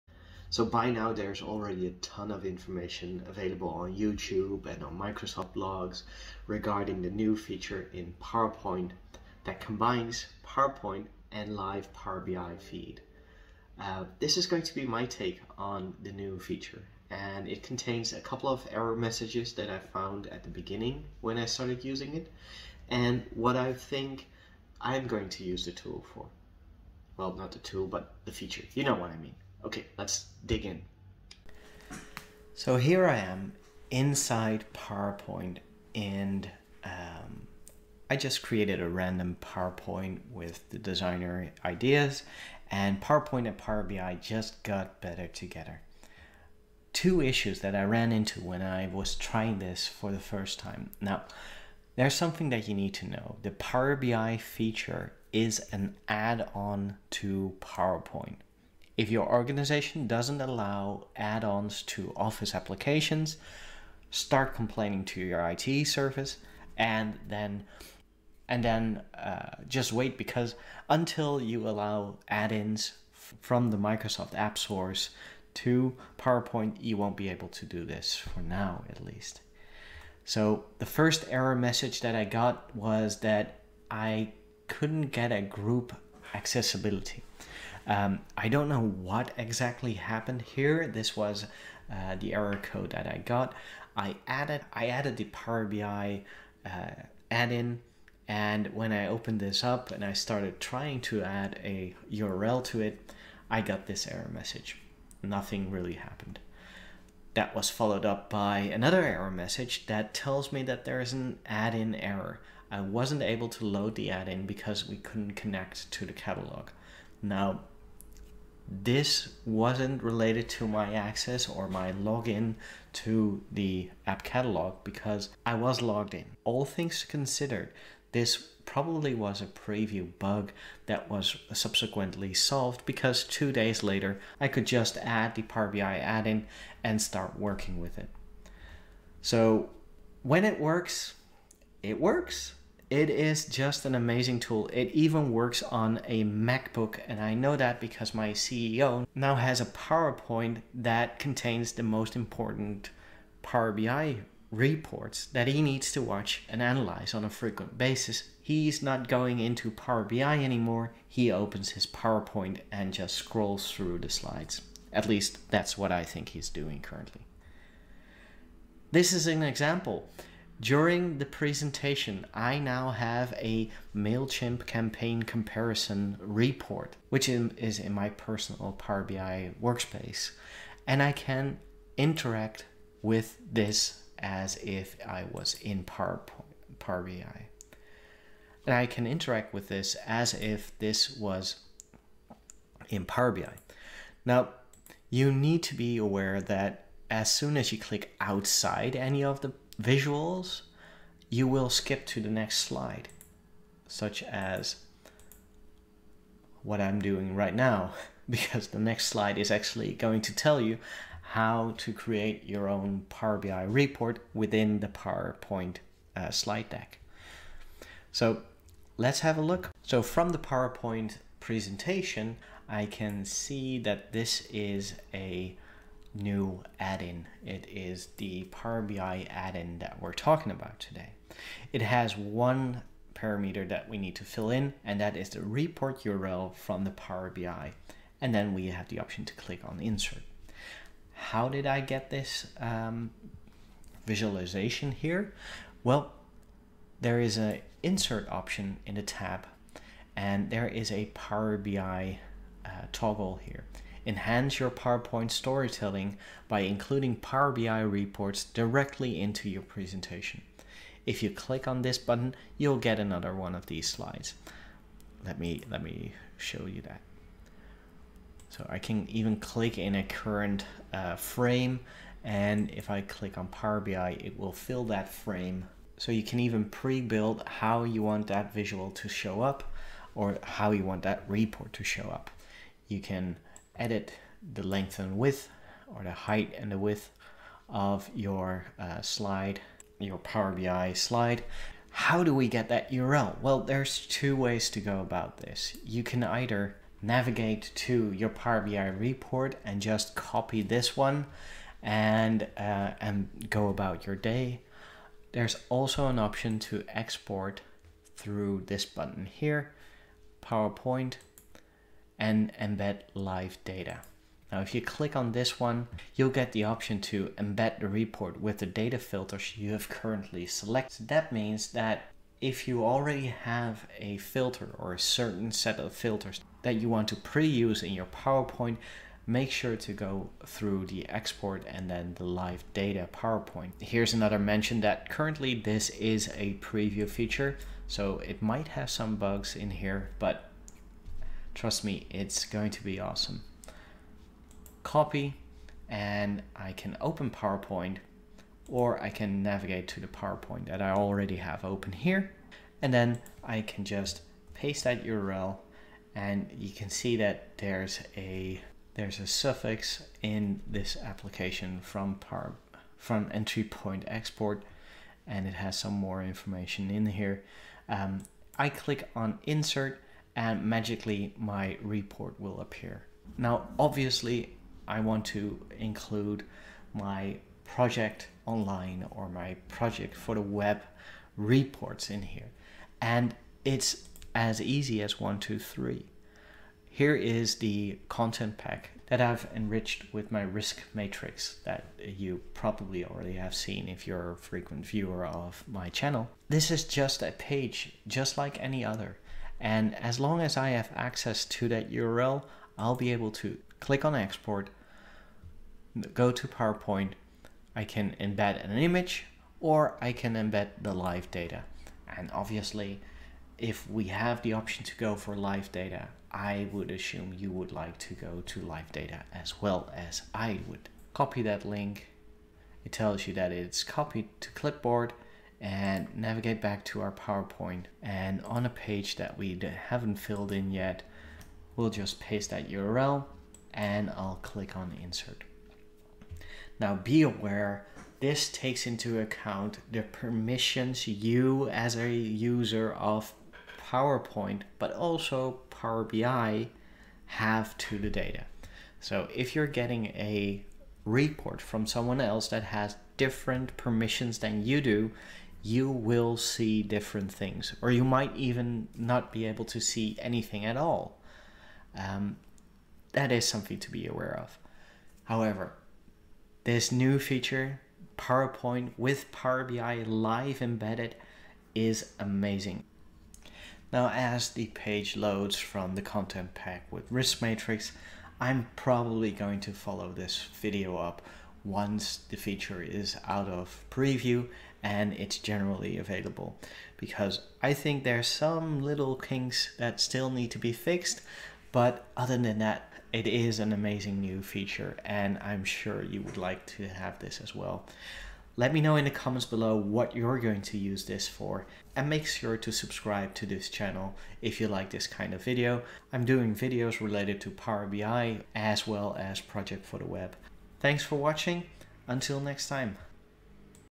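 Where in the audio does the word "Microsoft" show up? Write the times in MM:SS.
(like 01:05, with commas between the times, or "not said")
00:04, 01:13.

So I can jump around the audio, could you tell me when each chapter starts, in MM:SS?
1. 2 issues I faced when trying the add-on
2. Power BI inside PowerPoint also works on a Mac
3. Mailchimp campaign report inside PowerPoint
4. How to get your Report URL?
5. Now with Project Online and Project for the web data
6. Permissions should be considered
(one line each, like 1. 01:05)
1. 00:46
2. 02:20
3. 02:48
4. 04:55
5. 06:13
6. 07:15.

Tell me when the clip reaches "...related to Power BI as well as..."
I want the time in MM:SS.
08:27.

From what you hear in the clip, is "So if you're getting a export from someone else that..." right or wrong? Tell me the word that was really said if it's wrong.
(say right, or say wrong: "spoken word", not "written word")
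wrong: "report", not "export".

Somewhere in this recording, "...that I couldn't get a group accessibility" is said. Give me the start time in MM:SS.
01:23.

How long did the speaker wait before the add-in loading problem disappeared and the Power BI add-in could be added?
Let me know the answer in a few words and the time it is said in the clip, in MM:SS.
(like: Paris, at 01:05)
Two days, at 02:13.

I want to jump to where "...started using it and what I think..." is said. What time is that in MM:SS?
00:21.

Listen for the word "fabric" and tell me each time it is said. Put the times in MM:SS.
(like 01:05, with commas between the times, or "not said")
not said.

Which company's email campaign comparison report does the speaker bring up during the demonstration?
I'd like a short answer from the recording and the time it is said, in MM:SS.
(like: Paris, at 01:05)
MailChimp, at 02:53.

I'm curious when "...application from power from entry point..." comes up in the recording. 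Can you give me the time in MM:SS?
06:01.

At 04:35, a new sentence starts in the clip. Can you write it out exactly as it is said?
So you can even pre-build how you want that visual to show up or how you want that report to show up.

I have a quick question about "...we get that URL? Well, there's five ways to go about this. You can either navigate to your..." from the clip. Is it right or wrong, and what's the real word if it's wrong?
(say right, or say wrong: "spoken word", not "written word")
wrong: "two", not "five".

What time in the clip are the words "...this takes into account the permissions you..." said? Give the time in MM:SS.
07:18.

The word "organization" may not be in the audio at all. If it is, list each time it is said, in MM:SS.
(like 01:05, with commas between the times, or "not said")
00:59.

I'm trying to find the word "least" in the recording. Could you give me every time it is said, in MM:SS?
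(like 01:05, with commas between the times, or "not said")
01:19, 02:45.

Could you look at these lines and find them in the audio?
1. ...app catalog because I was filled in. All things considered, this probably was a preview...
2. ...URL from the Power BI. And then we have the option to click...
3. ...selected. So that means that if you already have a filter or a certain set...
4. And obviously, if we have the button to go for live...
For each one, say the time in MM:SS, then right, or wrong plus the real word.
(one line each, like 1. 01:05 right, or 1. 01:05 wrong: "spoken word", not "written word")
1. 02:04 wrong: "logged", not "filled"
2. 03:56 right
3. 05:20 right
4. 06:52 wrong: "option", not "button".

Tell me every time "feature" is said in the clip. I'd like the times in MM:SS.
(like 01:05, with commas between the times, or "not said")
00:07, 00:16, 00:28, 00:54, 05:37, 07:47, 08:02, 08:14.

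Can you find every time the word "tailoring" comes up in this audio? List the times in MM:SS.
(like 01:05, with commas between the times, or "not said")
not said.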